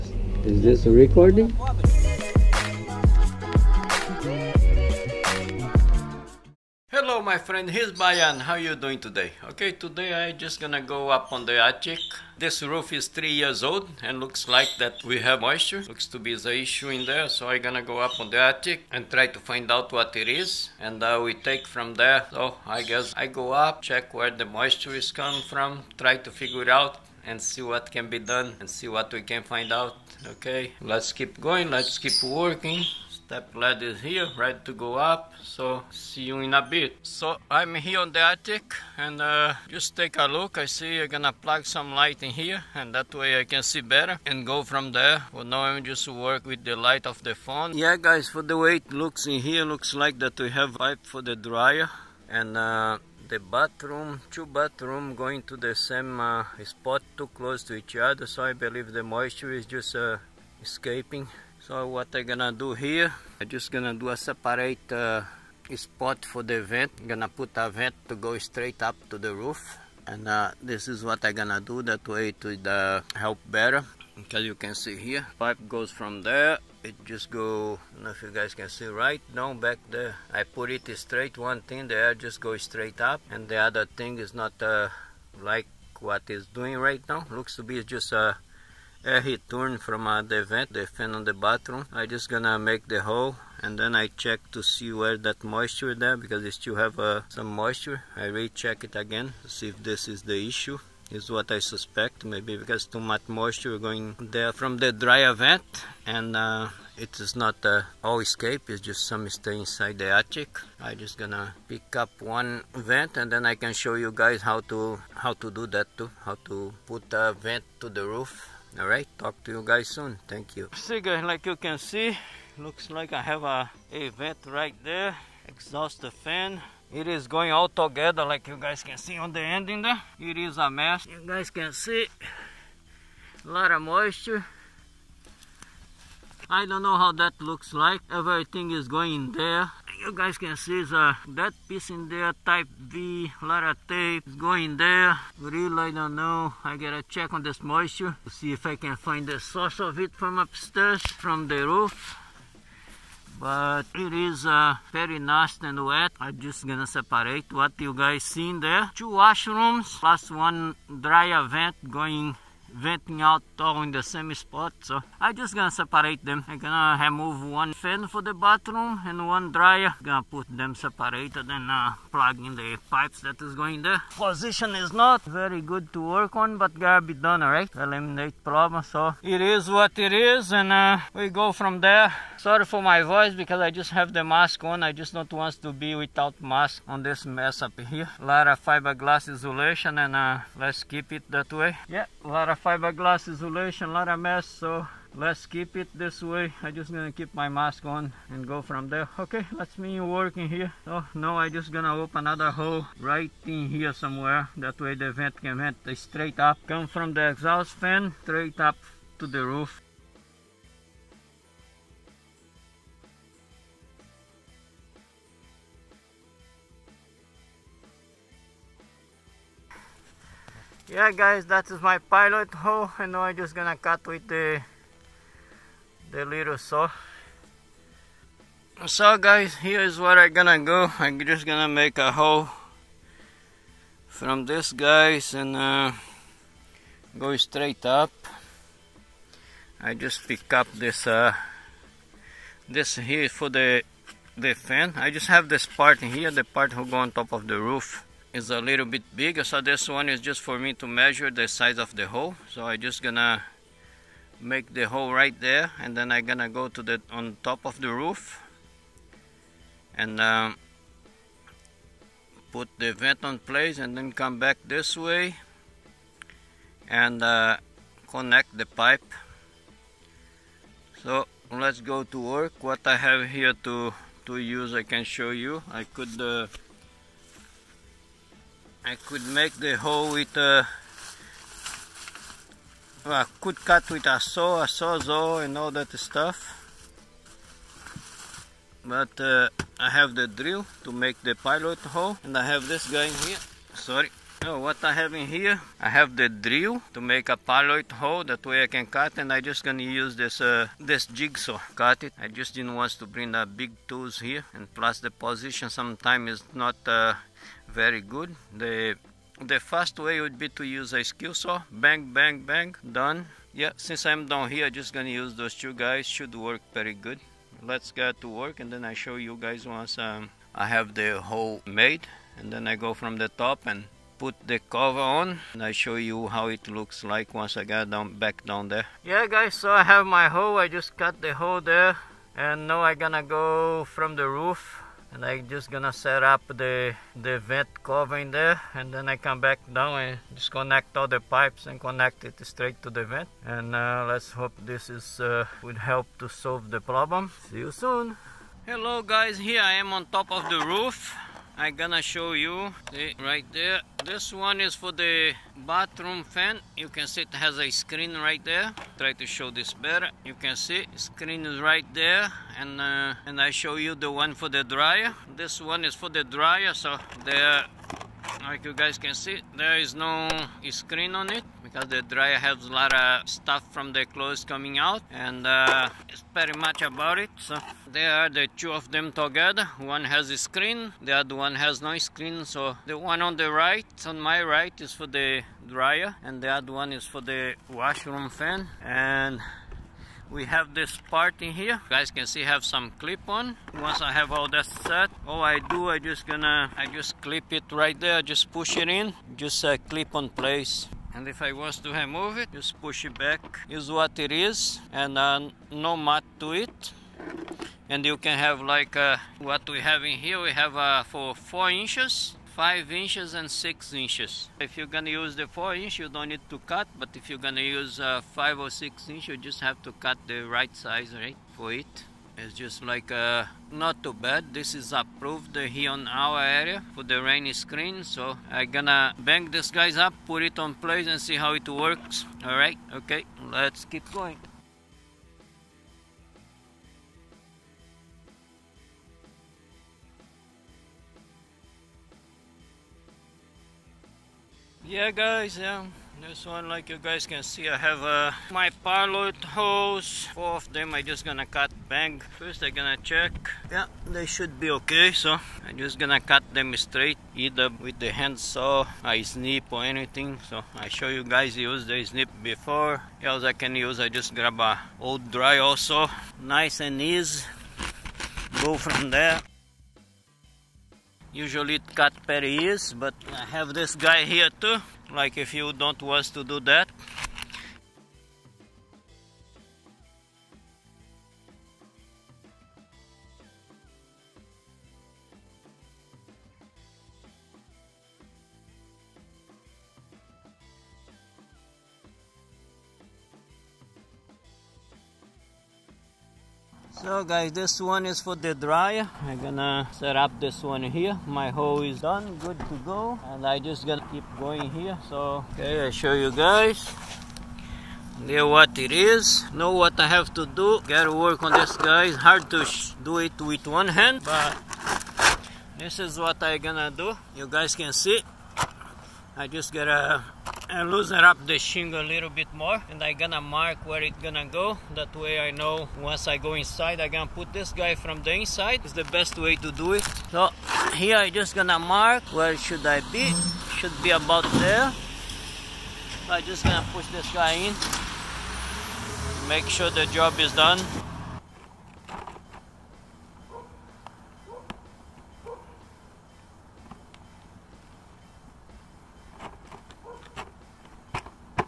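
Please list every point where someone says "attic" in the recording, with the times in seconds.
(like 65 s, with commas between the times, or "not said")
11 s, 18 s, 38 s, 110 s.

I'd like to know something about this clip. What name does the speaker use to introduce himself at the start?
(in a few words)
Bahiano.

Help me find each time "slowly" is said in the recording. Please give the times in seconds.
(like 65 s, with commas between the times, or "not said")
not said.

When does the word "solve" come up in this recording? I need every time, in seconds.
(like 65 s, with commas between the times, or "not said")
346 s.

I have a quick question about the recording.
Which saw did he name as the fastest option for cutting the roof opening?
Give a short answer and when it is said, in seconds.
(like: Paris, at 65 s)
Skill saw, at 311 s.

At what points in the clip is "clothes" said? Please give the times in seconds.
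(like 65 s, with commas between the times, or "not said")
374 s.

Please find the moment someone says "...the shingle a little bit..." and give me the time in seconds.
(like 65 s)
521 s.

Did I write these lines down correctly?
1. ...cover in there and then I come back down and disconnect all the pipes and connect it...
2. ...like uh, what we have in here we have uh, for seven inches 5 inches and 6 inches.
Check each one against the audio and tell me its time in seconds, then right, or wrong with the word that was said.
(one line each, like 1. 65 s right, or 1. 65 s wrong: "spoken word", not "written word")
1. 337 s right
2. 408 s wrong: "four", not "seven".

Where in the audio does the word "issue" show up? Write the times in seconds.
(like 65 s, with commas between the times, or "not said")
16 s, 100 s.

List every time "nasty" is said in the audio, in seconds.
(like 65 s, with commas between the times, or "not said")
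155 s.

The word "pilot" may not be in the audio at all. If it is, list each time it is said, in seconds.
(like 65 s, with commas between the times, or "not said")
221 s, 291 s, 297 s, 448 s.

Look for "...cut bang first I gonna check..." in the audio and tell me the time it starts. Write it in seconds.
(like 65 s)
451 s.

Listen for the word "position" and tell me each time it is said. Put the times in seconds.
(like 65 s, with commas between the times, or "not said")
174 s, 305 s.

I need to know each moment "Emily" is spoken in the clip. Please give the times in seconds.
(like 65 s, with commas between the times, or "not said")
not said.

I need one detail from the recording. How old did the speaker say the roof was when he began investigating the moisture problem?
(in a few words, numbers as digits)
3 years.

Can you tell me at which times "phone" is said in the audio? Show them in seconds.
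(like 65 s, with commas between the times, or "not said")
47 s.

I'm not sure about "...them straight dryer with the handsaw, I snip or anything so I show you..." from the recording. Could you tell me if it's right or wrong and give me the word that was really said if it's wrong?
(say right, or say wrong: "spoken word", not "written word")
wrong: "either", not "dryer".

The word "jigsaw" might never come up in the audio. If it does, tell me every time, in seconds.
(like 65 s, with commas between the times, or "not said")
301 s.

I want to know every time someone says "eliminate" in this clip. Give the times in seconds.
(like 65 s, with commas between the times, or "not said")
177 s.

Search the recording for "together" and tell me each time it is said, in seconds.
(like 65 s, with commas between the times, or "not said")
127 s, 379 s.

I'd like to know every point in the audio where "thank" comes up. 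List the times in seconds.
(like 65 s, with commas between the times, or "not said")
120 s.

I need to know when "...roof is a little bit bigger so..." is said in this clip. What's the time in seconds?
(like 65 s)
247 s.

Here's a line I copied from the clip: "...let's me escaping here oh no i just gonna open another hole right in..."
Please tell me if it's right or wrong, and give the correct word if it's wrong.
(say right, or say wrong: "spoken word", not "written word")
wrong: "working", not "escaping".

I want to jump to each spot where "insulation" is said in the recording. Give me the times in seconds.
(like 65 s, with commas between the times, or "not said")
189 s, 193 s.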